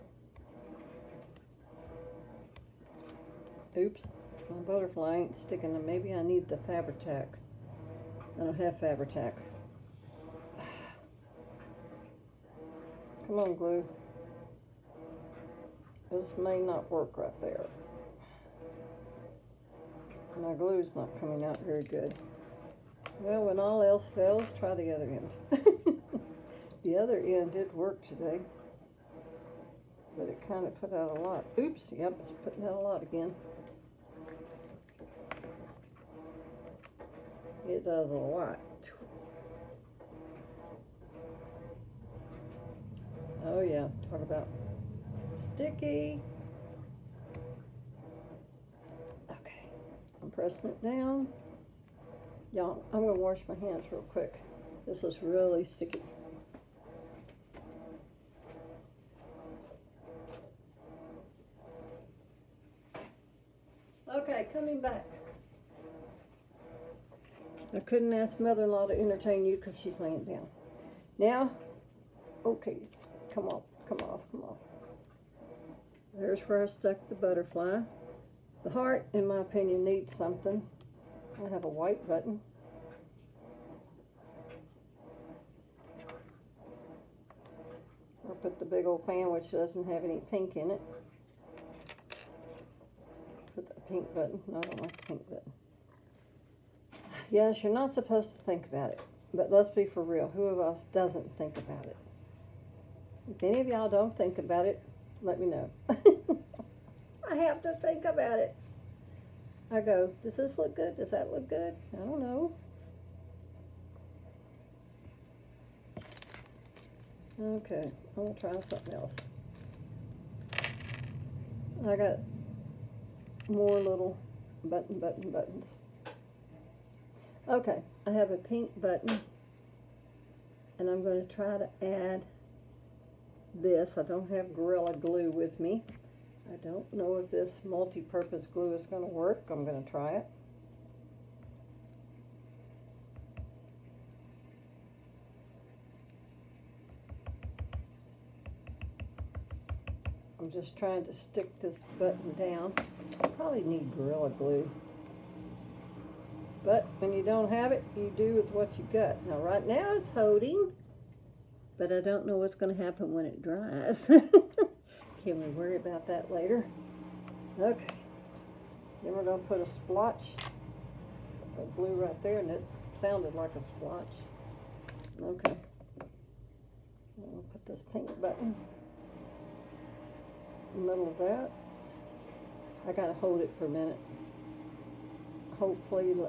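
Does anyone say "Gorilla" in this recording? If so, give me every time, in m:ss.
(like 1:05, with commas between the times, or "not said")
2:14, 2:33.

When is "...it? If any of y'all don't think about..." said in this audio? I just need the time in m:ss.
1:41.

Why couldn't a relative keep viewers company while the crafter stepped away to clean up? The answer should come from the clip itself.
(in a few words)
She's laying down.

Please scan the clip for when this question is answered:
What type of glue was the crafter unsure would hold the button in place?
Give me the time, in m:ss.
2:17.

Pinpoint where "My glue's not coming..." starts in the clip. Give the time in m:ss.
0:20.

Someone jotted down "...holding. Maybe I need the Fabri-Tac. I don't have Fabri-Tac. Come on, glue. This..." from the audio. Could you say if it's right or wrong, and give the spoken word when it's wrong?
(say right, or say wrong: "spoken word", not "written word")
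wrong: "sticking", not "holding".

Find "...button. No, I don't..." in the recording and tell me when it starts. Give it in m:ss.
1:34.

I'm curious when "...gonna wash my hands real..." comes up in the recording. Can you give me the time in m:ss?
0:53.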